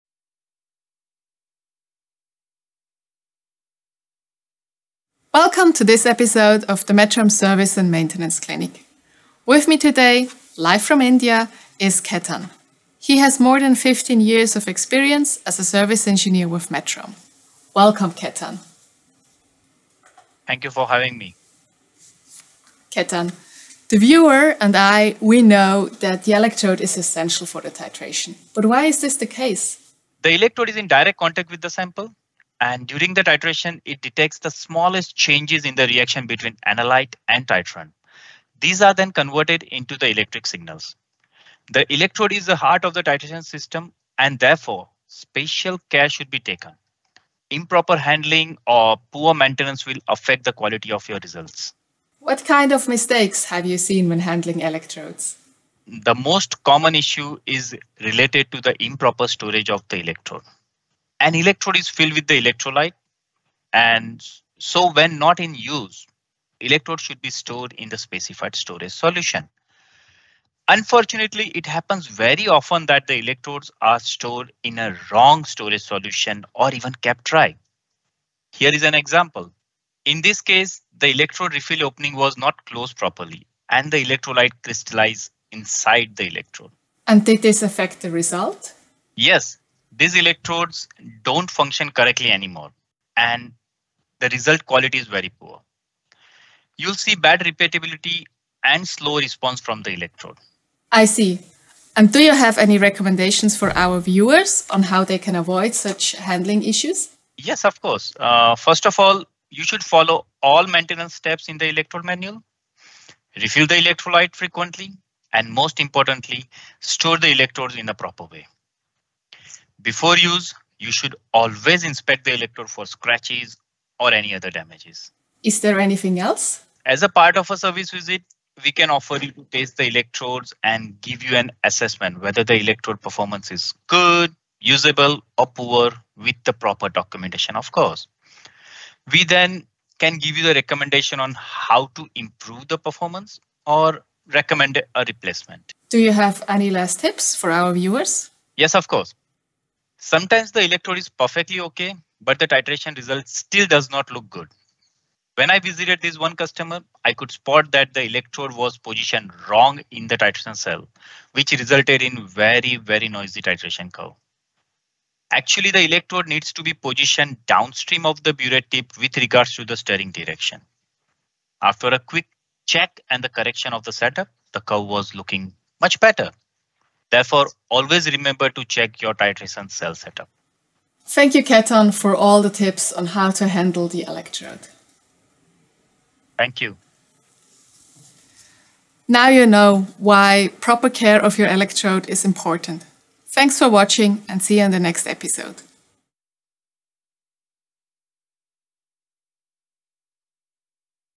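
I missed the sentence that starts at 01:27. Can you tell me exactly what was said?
And did this affect the result?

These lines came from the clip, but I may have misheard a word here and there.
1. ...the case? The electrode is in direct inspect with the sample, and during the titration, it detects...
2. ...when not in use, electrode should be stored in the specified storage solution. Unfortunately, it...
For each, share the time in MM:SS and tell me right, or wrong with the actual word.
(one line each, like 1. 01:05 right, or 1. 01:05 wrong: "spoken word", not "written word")
1. 00:29 wrong: "contact", not "inspect"
2. 01:04 right.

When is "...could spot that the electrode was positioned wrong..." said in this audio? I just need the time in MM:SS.
02:37.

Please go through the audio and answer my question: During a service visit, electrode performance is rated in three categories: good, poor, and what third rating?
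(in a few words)
Usable.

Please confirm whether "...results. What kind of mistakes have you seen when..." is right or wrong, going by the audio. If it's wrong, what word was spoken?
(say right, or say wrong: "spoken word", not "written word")
right.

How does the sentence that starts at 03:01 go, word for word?
Thank you, Ketan, for all the tips on how to handle the electrode.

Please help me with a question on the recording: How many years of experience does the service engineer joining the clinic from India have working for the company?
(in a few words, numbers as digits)
More than 15.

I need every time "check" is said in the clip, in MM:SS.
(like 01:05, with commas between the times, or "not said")
02:52, 02:58.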